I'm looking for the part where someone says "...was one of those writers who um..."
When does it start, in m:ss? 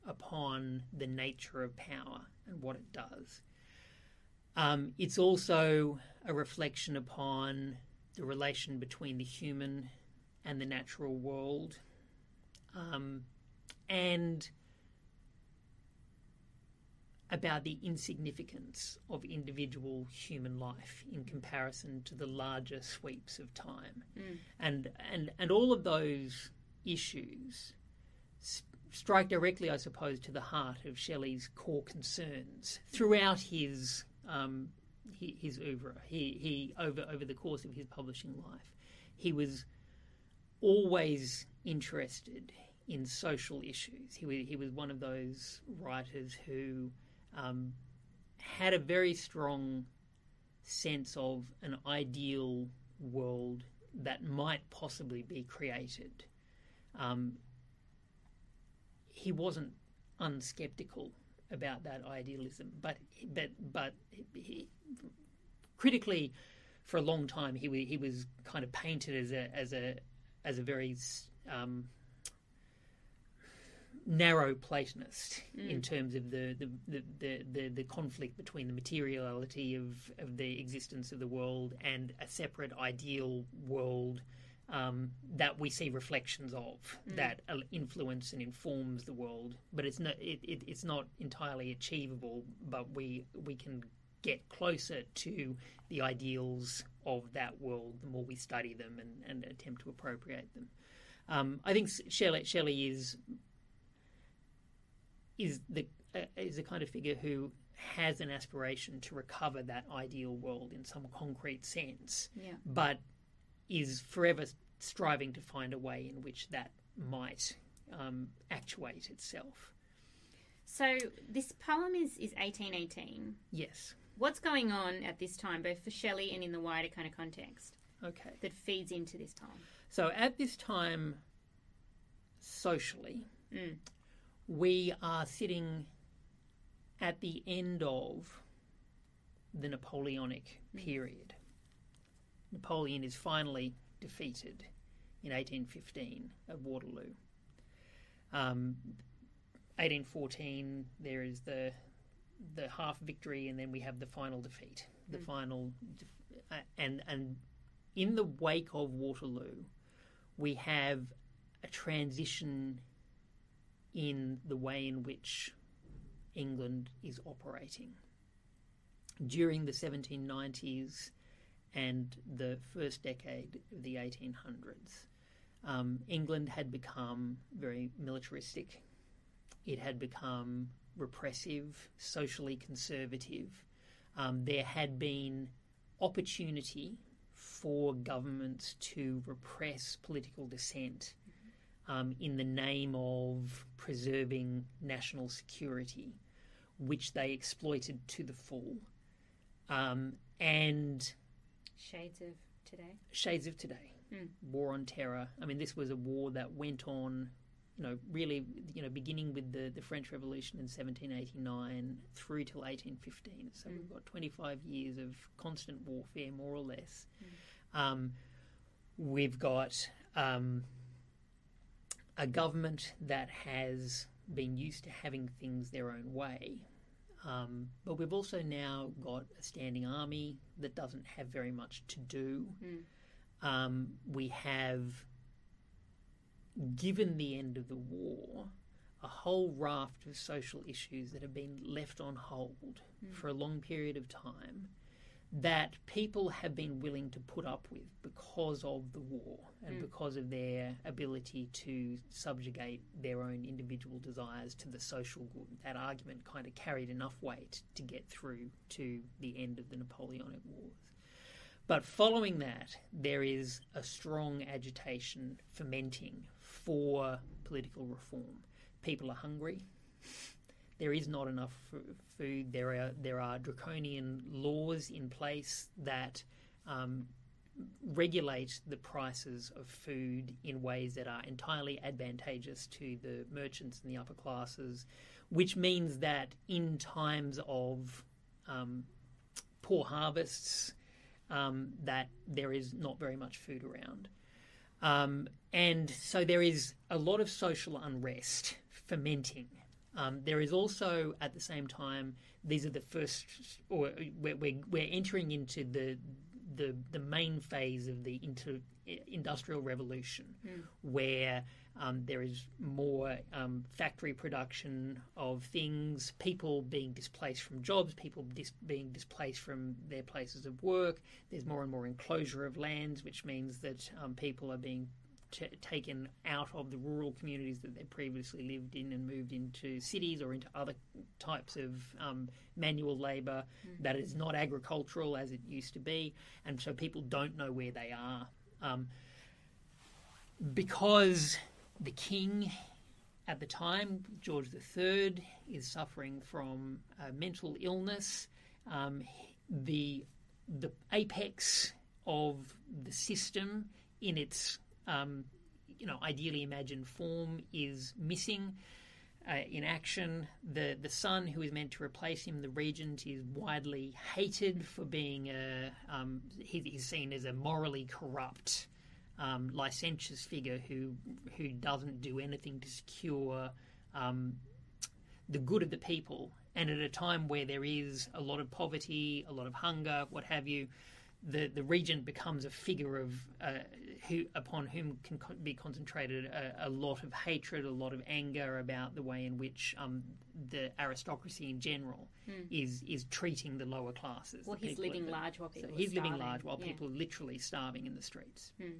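0:44.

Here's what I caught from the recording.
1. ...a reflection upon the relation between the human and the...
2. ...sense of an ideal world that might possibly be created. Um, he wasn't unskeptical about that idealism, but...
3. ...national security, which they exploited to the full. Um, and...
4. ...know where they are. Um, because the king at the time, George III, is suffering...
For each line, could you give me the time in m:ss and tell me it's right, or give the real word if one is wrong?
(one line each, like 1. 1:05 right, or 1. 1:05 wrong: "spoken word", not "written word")
1. 0:06 right
2. 0:50 right
3. 3:14 right
4. 5:37 right.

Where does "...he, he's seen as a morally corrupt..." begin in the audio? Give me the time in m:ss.
6:06.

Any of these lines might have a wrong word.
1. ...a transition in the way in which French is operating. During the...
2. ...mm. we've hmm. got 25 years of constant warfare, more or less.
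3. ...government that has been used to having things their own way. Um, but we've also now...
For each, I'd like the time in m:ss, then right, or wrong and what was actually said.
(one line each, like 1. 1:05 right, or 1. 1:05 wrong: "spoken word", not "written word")
1. 2:41 wrong: "England", not "French"
2. 3:33 right
3. 3:42 right.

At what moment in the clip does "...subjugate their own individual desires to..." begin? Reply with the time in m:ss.
4:12.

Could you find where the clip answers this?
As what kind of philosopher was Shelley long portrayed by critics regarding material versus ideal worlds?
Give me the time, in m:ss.
1:14.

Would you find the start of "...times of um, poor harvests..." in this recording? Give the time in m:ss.
4:46.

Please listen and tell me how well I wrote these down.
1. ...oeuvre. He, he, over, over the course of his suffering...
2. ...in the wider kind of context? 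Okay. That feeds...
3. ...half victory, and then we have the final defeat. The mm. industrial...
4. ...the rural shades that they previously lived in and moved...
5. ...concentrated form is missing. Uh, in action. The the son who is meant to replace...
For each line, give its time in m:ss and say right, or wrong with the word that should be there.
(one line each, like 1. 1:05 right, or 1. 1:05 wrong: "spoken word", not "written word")
1. 0:35 wrong: "publishing", not "suffering"
2. 2:06 right
3. 2:32 wrong: "final", not "industrial"
4. 5:26 wrong: "communities", not "shades"
5. 5:56 wrong: "imagined", not "concentrated".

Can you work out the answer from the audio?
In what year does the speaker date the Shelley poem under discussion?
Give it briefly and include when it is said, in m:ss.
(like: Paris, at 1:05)
1818, at 2:02.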